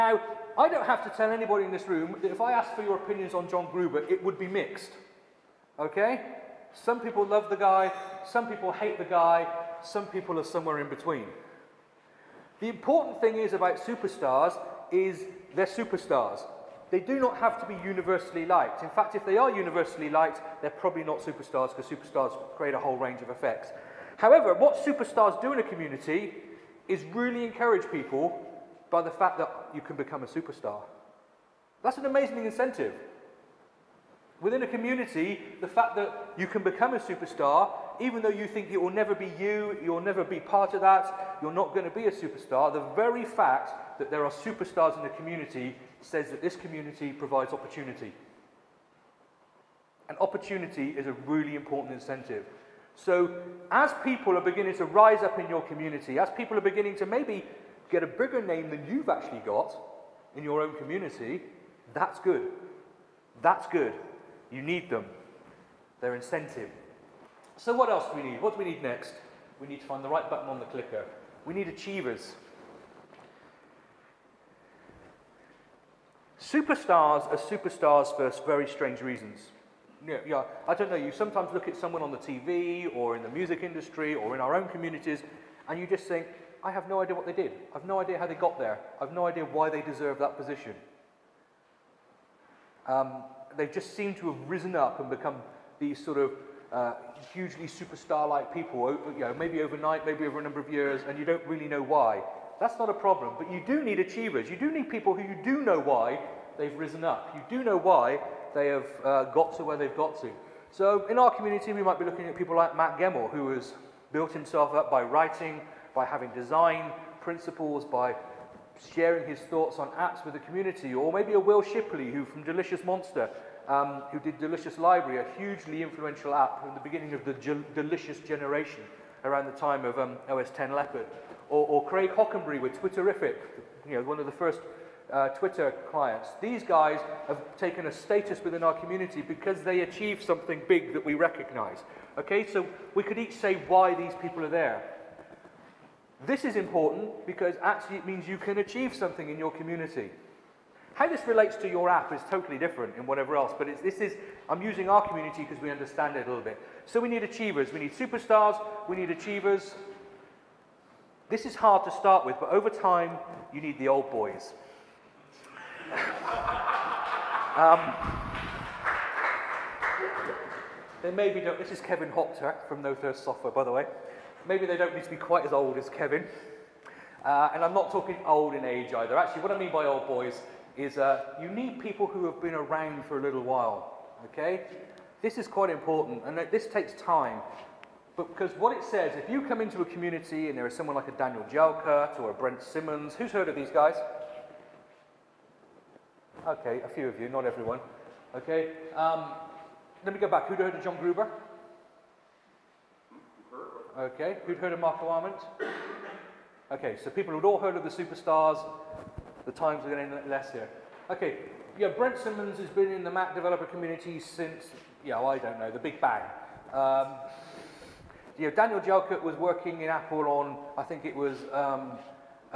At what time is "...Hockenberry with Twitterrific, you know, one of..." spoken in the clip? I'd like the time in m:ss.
2:12.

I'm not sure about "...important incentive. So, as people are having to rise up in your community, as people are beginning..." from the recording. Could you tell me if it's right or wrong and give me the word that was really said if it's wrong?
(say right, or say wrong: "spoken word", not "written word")
wrong: "beginning", not "having".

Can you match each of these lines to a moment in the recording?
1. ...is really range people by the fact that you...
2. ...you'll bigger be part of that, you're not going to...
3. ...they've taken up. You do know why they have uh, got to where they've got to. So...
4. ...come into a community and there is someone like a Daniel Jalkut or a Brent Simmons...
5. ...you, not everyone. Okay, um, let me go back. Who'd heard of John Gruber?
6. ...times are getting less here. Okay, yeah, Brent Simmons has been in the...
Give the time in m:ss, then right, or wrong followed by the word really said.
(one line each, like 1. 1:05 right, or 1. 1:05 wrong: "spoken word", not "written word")
1. 0:26 wrong: "encourage", not "range"
2. 0:39 wrong: "never", not "bigger"
3. 1:46 wrong: "risen", not "taken"
4. 3:09 right
5. 3:17 right
6. 3:29 right.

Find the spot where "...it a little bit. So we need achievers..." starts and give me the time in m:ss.
2:36.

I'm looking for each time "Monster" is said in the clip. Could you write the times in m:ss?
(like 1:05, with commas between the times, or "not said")
2:02.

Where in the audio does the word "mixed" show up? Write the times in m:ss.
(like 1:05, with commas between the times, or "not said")
0:04.